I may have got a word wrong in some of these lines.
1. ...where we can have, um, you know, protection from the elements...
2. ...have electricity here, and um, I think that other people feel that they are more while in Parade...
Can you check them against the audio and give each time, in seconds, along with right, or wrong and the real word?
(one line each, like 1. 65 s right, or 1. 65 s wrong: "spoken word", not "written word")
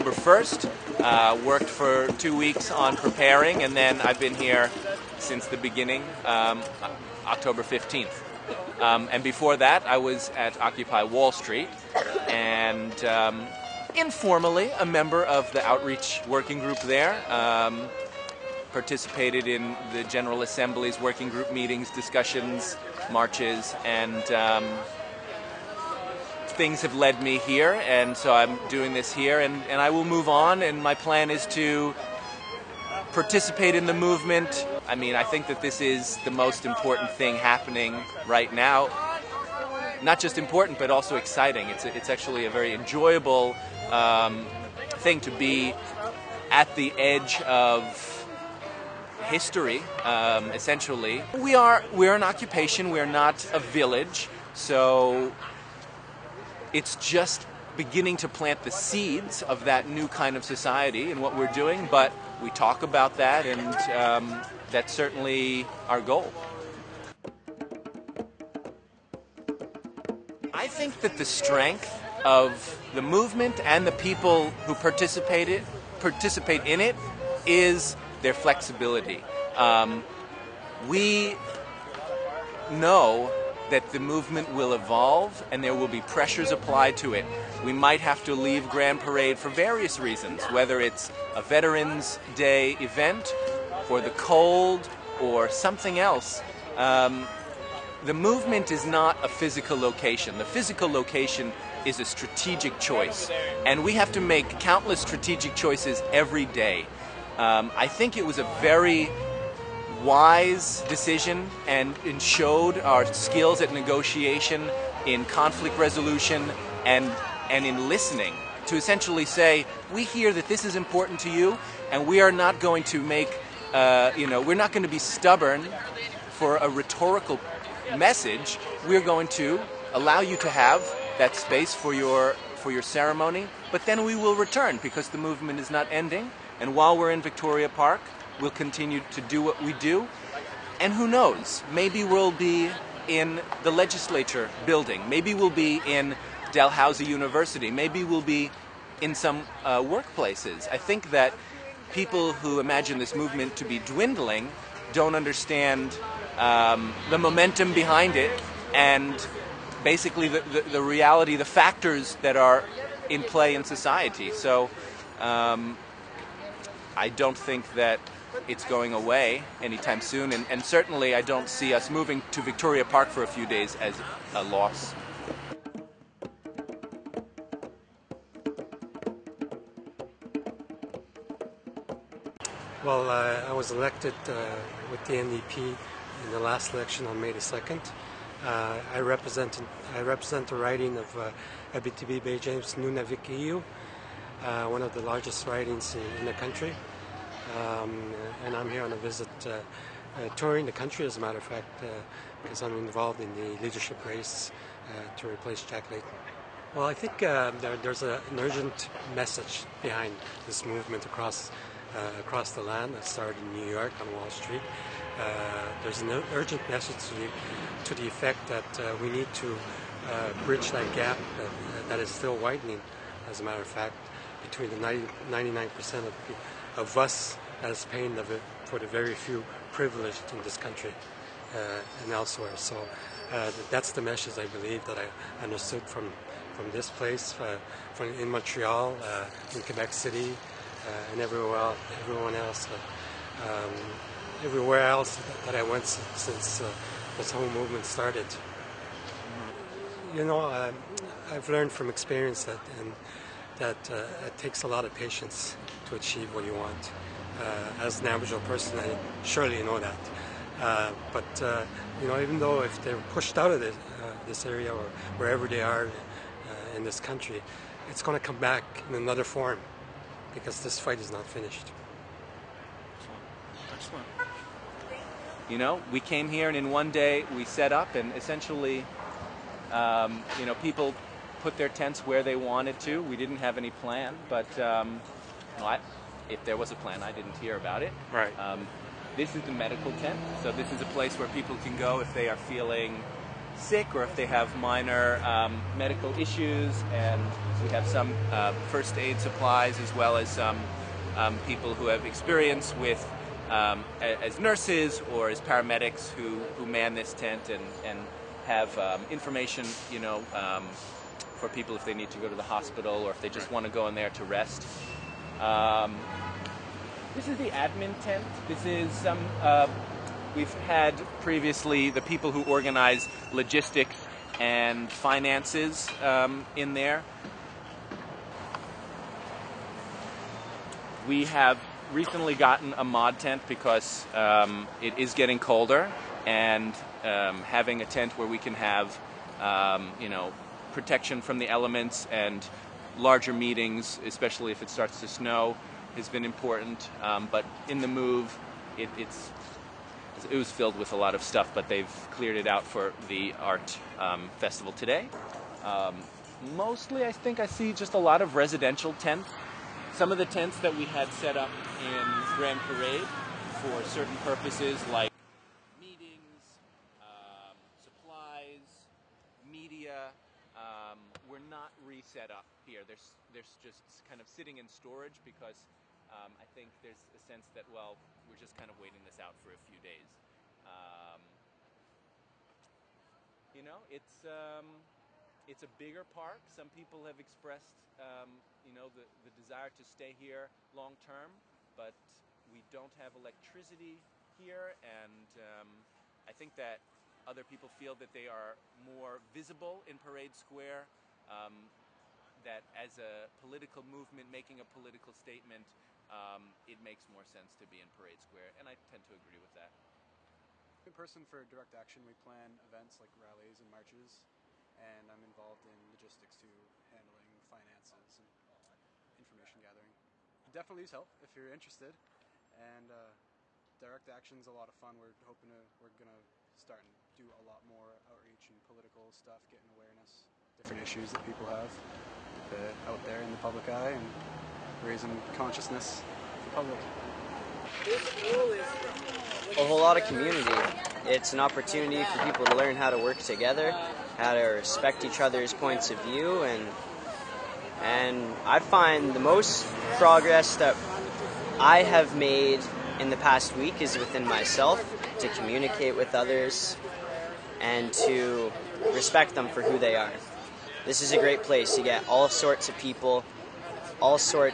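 1. 338 s right
2. 392 s wrong: "visible", not "while".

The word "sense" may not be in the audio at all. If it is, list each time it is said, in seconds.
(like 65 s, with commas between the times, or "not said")
377 s, 407 s.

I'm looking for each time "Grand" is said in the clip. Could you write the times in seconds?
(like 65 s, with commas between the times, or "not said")
88 s, 362 s.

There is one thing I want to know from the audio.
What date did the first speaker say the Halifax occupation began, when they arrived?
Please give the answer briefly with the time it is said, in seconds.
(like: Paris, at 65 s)
October 15th, at 7 s.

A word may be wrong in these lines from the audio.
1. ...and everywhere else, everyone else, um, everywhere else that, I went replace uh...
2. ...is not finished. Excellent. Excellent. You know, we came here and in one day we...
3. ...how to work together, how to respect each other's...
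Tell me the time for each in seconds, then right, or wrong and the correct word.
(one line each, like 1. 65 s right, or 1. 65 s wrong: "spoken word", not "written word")
1. 241 s wrong: "since", not "replace"
2. 270 s right
3. 442 s right.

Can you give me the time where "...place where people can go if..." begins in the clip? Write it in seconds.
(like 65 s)
290 s.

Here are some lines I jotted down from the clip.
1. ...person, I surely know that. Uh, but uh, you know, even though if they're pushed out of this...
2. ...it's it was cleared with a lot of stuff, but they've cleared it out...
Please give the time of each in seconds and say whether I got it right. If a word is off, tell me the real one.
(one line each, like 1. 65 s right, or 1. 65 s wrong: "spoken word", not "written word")
1. 258 s right
2. 348 s wrong: "filled", not "cleared".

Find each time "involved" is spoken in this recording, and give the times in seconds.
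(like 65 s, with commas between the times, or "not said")
202 s, 415 s.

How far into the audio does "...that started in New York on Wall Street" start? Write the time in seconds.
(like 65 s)
212 s.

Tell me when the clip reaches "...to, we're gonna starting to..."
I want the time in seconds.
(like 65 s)
425 s.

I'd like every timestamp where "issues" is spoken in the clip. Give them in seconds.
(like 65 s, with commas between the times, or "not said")
296 s, 430 s.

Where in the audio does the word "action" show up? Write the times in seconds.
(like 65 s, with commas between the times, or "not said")
411 s, 424 s.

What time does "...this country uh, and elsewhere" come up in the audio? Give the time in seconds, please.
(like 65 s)
230 s.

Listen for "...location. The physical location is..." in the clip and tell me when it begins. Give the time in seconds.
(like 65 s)
99 s.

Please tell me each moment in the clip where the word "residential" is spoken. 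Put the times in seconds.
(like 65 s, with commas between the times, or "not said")
358 s.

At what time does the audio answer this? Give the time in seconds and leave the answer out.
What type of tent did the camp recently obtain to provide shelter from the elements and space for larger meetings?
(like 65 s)
332 s.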